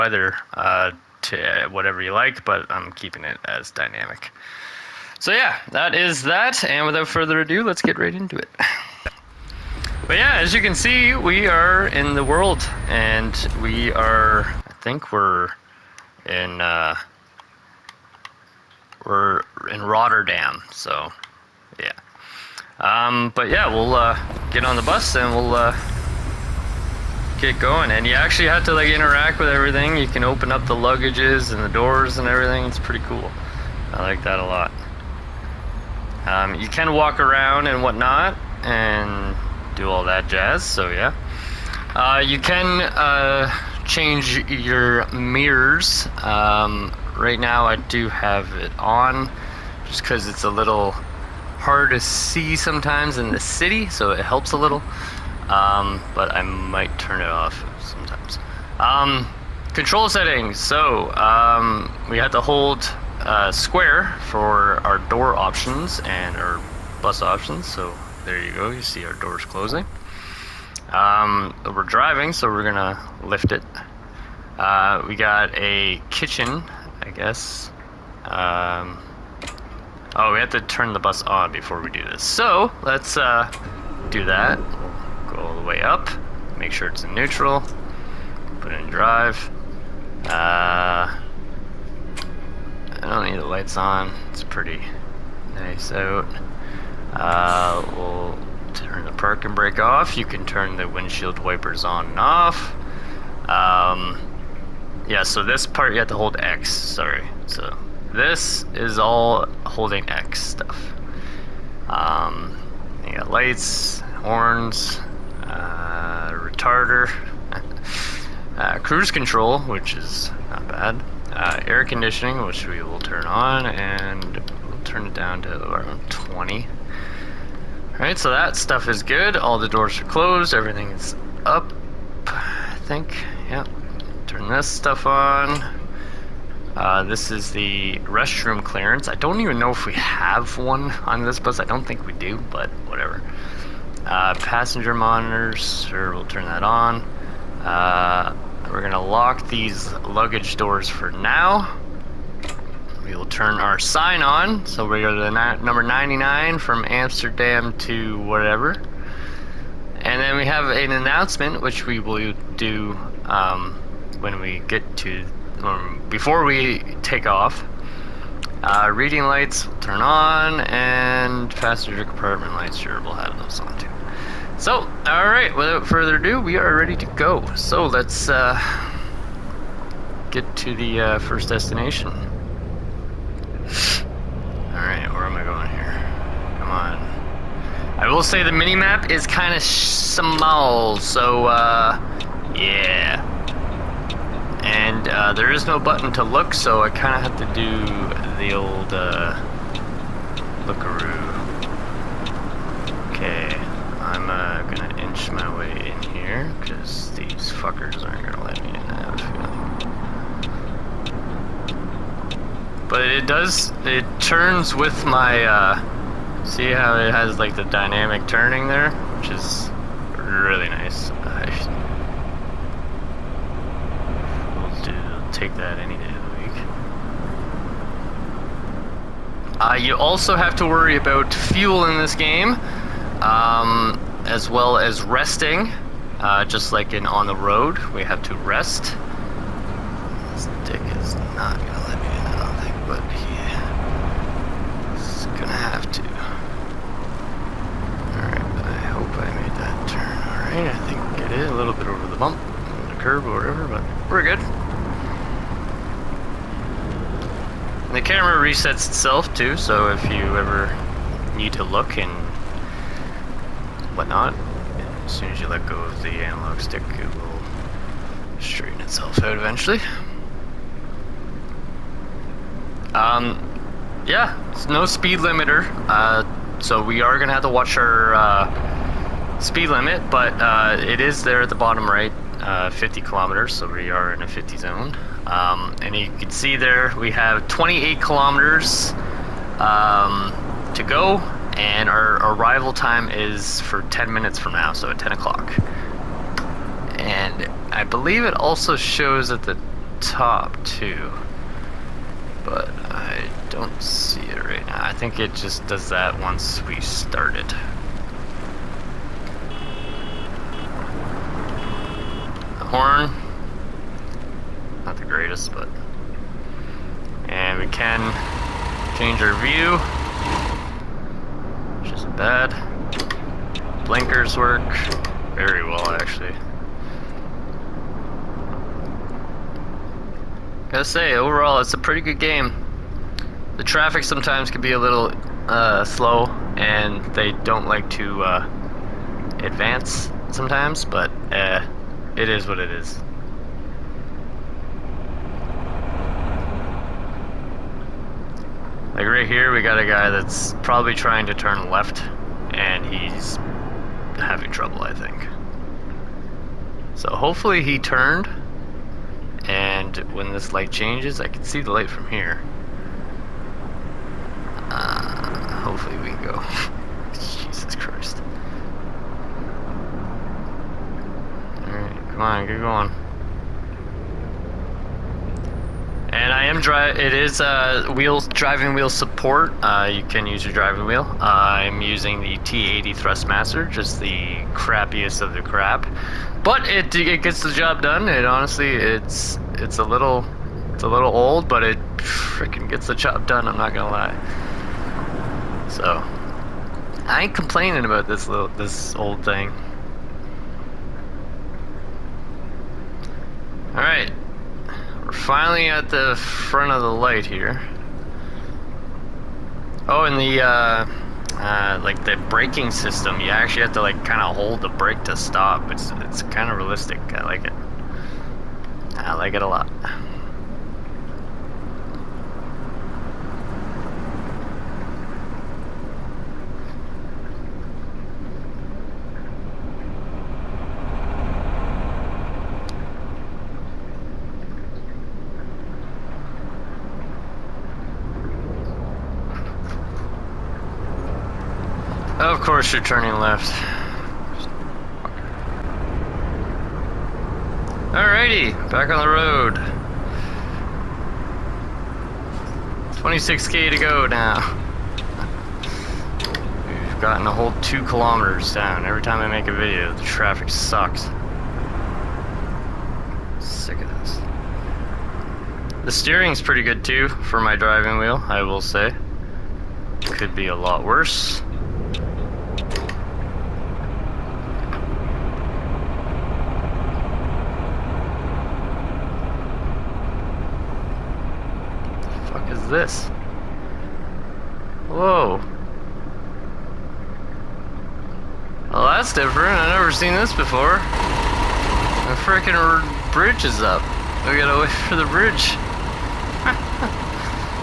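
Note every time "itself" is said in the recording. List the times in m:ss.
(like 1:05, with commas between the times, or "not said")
4:18, 4:28.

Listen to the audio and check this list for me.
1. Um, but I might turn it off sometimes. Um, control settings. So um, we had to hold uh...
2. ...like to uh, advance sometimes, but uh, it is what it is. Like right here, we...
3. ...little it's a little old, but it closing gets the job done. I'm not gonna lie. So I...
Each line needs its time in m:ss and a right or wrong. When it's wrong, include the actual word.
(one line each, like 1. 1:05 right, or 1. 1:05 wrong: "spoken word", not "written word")
1. 0:55 right
2. 5:37 right
3. 6:29 wrong: "freaking", not "closing".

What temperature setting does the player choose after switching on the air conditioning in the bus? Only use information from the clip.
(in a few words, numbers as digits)
20.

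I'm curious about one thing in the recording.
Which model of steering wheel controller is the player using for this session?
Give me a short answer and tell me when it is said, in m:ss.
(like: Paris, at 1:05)
Thrustmaster T80, at 6:22.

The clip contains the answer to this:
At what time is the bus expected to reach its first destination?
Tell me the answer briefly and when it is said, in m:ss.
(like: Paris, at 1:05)
10 o'clock, at 4:54.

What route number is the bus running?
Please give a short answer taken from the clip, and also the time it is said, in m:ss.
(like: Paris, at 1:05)
99, at 2:35.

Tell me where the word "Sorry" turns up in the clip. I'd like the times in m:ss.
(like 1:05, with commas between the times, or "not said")
1:46.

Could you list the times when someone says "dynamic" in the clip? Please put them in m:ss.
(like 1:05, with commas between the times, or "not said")
0:03, 3:37.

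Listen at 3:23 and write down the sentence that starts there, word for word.
Okay, I'm uh, gonna inch my way in here, because these fuckers aren't gonna let me in, I have a feeling.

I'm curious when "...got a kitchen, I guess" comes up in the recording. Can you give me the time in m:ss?
1:15.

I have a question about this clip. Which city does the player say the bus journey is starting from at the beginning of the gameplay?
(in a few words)
Rotterdam.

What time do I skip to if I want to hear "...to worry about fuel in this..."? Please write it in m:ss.
3:50.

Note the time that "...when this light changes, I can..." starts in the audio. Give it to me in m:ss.
6:00.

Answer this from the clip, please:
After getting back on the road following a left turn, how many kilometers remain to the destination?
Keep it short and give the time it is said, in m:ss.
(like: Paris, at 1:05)
26, at 7:32.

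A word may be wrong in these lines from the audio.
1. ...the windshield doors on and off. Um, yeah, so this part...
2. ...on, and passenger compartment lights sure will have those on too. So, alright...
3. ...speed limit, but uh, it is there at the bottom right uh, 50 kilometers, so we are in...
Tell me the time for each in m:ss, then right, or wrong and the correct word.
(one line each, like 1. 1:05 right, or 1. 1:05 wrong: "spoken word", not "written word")
1. 1:40 wrong: "wipers", not "doors"
2. 2:50 right
3. 4:39 right.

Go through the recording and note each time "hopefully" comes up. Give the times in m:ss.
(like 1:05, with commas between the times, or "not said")
5:57, 6:05.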